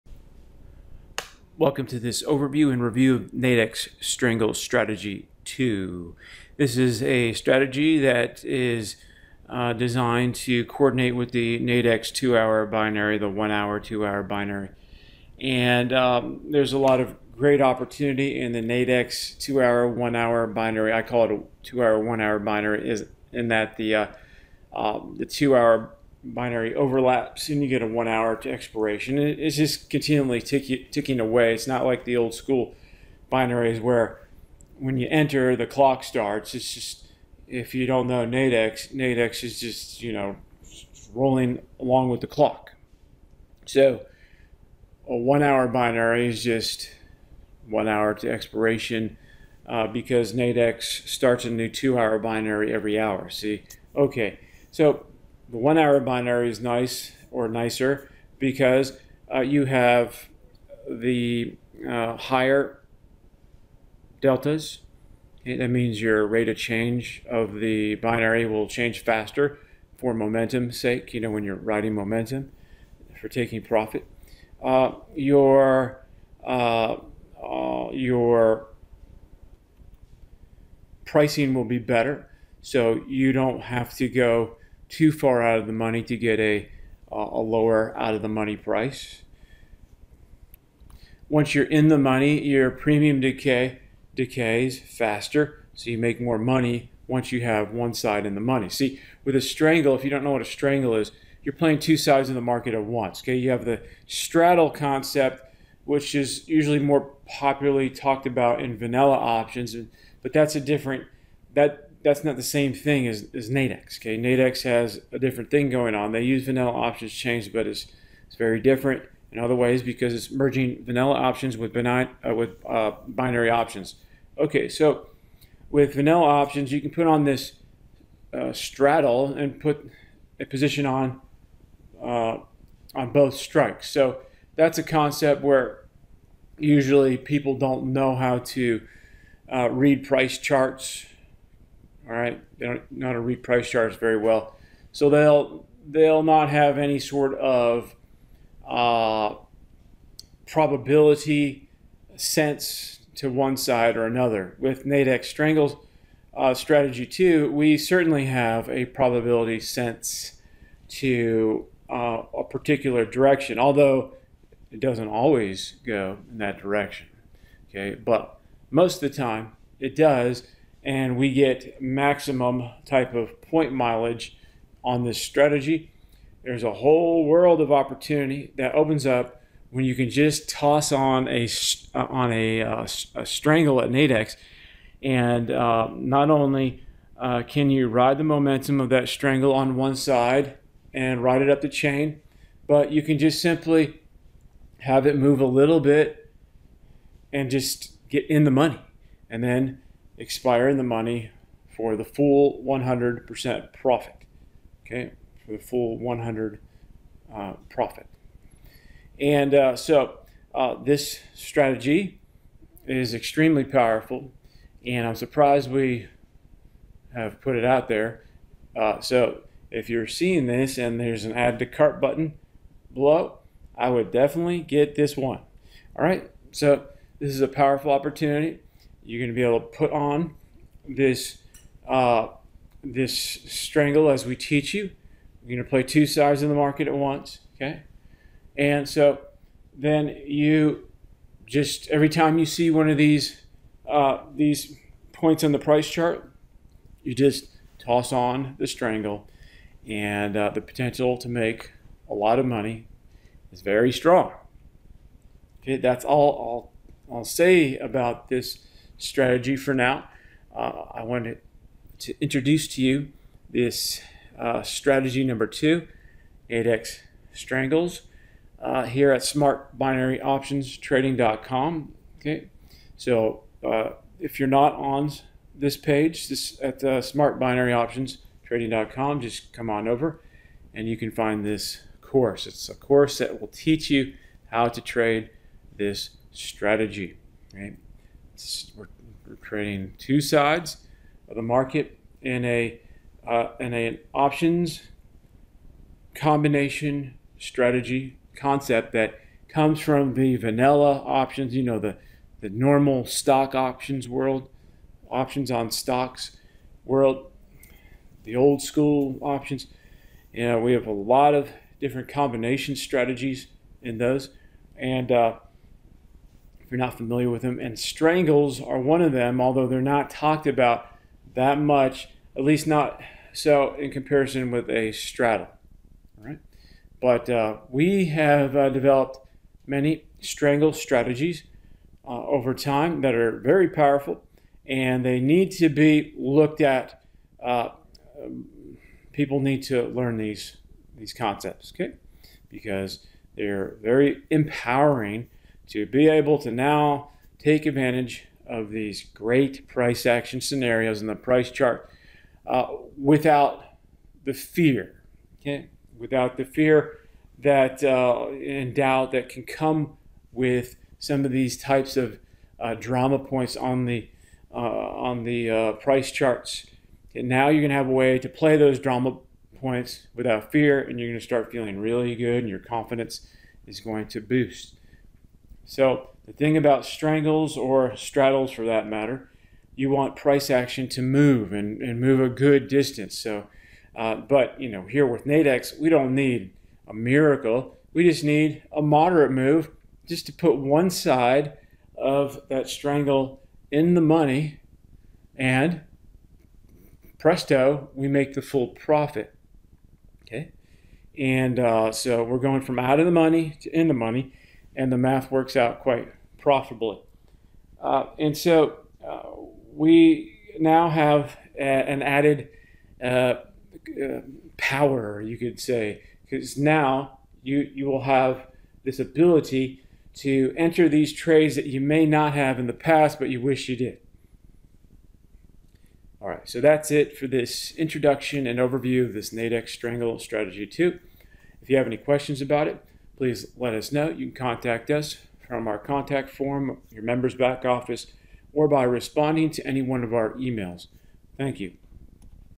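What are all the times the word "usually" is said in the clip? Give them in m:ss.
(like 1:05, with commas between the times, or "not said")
1:46, 2:16.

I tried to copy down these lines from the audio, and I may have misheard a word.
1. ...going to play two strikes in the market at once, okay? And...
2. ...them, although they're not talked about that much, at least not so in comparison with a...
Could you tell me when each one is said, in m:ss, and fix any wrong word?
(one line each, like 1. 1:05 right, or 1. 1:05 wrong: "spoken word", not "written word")
1. 3:55 wrong: "sides", not "strikes"
2. 5:19 right.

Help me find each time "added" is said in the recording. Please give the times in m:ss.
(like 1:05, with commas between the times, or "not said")
6:52.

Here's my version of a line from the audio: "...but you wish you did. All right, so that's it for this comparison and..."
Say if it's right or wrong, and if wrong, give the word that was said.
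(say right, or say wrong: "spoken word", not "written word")
wrong: "introduction", not "comparison".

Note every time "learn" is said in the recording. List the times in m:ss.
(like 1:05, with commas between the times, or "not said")
5:39.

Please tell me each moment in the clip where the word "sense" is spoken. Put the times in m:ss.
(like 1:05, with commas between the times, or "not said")
2:32, 2:39.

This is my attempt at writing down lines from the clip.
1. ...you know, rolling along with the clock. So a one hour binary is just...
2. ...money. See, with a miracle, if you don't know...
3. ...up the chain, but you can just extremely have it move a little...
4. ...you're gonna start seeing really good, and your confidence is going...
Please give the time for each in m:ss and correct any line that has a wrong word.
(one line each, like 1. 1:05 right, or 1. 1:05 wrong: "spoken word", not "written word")
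1. 0:40 right
2. 1:38 wrong: "strangle", not "miracle"
3. 3:11 wrong: "simply", not "extremely"
4. 6:10 wrong: "feeling", not "seeing".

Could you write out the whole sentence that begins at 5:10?
You know, we have a lot of different combination strategies in those.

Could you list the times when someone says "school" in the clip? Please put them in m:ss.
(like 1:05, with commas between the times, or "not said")
0:32, 5:08.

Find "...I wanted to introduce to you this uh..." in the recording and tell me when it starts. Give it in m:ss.
4:20.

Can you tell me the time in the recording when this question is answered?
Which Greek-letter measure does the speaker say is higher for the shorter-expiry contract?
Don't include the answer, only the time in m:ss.
1:04.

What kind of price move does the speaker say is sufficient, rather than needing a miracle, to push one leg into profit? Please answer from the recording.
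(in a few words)
a moderate move.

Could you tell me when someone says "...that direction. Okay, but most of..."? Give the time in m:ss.
2:46.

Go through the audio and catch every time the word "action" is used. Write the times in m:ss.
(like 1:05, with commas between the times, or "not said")
5:50, 6:20.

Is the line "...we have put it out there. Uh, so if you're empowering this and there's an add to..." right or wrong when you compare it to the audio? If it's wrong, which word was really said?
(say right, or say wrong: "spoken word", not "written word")
wrong: "seeing", not "empowering".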